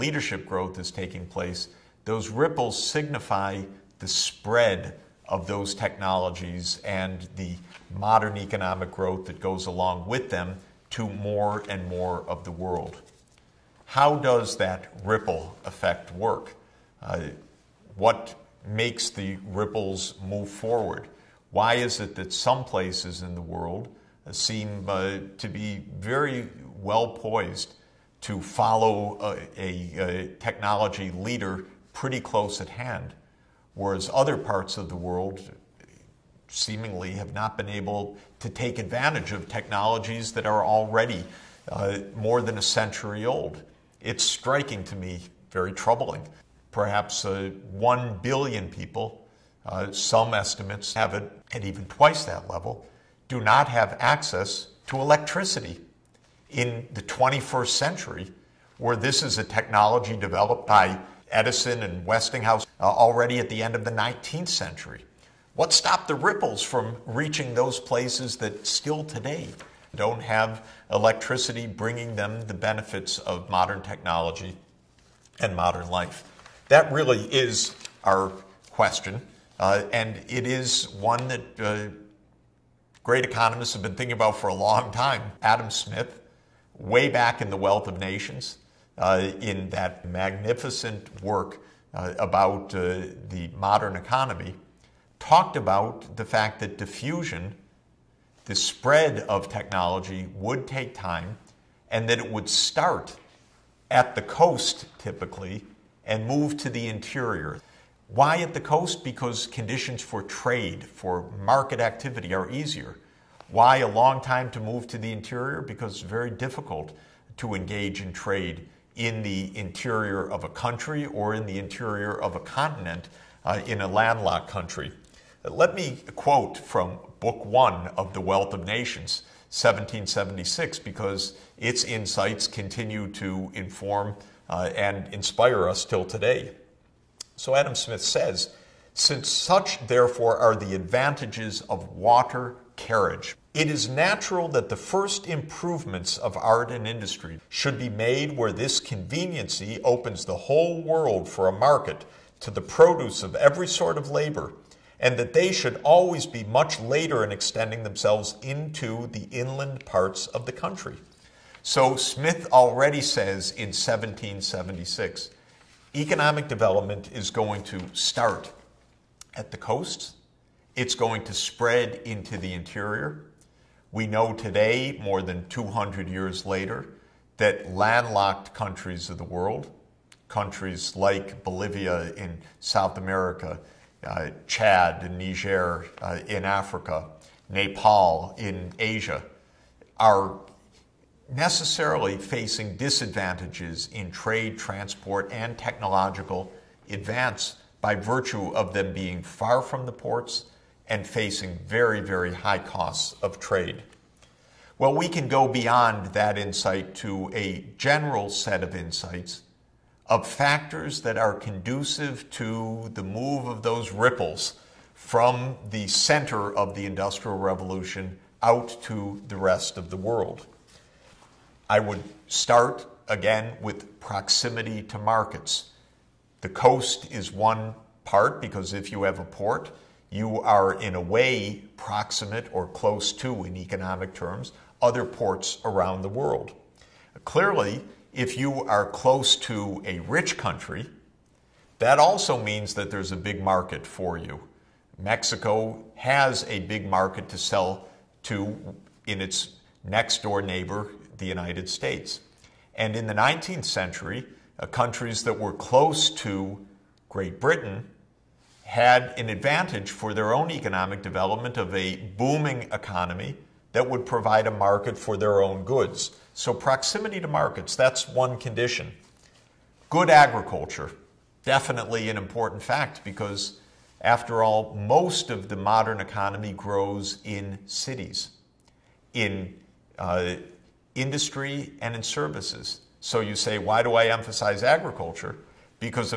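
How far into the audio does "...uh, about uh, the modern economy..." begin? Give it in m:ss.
1:31.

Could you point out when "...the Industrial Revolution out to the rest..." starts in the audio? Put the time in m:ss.
3:36.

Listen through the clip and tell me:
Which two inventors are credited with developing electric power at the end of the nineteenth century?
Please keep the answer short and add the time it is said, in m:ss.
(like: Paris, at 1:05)
Edison and Westinghouse, at 1:01.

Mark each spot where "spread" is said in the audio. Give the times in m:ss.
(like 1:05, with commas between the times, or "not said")
0:04, 1:38, 2:51.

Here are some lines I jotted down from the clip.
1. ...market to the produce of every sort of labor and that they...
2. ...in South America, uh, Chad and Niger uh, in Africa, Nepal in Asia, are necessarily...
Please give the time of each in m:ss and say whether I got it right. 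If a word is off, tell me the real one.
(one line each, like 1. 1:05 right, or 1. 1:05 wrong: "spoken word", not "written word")
1. 2:31 right
2. 3:02 right.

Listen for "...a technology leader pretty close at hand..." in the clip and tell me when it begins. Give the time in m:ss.
0:29.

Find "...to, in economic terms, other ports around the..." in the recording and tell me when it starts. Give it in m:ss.
3:53.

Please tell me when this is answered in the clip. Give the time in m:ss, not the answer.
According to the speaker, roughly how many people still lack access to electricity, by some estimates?
0:47.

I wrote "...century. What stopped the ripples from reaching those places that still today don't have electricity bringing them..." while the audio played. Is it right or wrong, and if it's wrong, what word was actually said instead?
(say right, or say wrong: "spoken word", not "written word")
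right.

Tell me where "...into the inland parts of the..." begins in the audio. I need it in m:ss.
2:38.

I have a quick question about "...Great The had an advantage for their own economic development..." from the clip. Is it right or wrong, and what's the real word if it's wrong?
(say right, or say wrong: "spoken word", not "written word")
wrong: "Britain", not "The".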